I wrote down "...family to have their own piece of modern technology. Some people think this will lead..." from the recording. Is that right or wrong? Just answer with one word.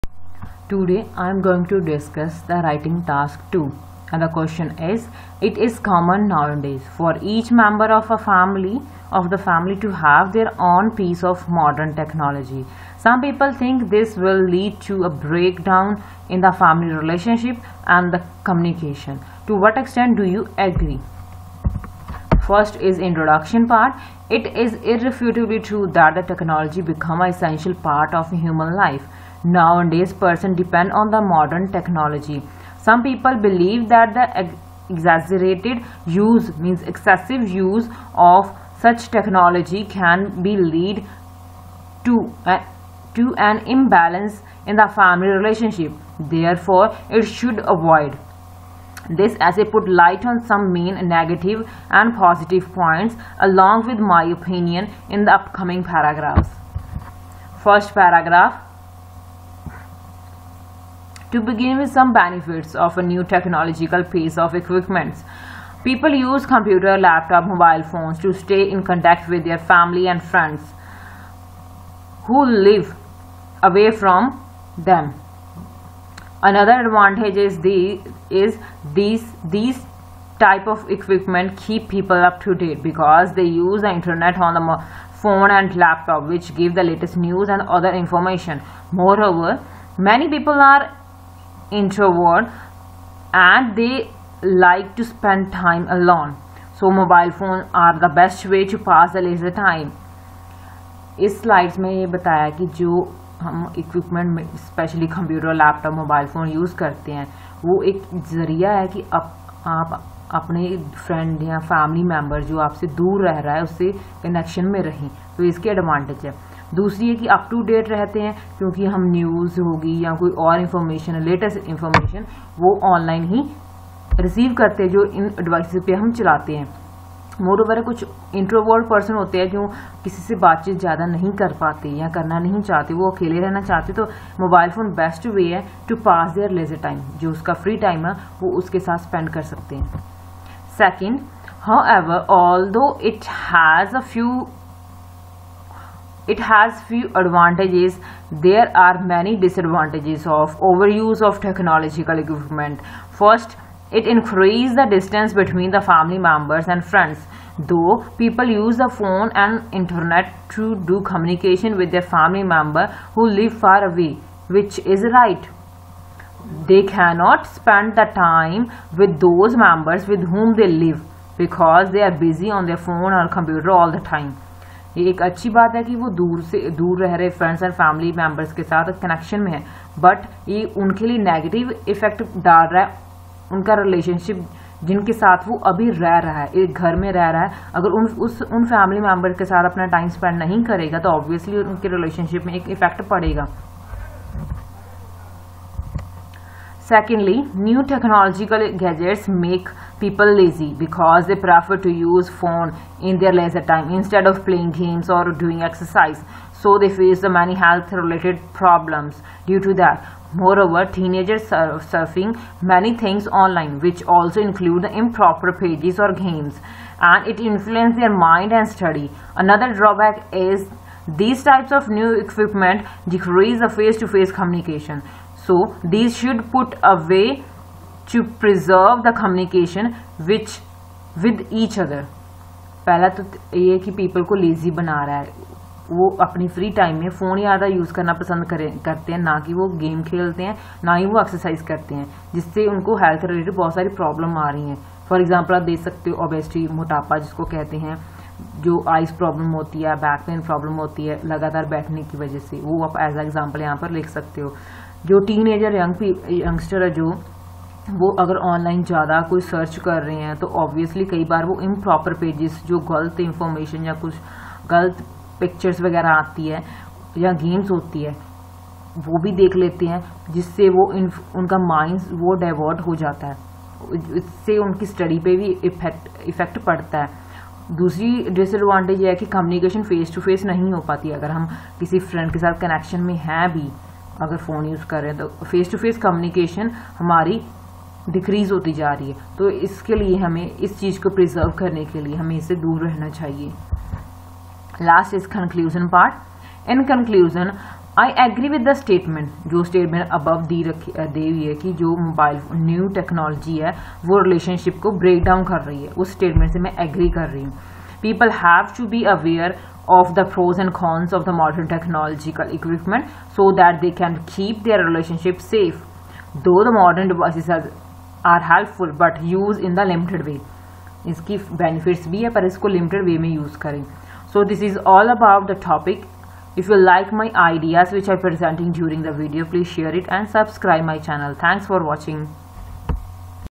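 right.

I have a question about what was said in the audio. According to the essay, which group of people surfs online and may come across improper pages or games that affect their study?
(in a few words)
teenagers.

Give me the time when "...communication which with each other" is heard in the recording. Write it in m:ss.
3:49.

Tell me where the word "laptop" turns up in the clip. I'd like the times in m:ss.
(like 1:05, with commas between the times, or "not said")
1:06, 1:25.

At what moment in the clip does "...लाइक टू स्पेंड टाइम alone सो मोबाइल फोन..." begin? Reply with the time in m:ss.
1:34.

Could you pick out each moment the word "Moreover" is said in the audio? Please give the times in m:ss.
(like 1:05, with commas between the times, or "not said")
1:28, 3:30.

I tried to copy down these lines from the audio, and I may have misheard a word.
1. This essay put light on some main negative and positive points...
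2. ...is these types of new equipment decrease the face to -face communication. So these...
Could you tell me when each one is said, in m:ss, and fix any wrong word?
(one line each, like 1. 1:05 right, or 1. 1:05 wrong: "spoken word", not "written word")
1. 0:49 right
2. 3:40 right.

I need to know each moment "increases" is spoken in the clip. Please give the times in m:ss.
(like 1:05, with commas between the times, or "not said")
2:34.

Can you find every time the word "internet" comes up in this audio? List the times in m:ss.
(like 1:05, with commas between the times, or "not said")
1:23, 2:39.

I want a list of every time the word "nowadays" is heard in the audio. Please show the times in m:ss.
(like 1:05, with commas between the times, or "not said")
0:06, 0:29.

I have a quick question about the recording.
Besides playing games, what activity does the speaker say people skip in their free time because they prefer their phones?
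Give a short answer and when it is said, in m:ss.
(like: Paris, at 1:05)
exercise, at 3:25.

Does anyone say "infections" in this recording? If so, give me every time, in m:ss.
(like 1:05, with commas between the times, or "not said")
not said.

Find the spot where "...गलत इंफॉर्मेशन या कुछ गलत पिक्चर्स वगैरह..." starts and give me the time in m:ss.
4:22.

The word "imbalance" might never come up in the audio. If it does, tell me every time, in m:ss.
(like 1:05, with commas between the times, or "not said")
0:43.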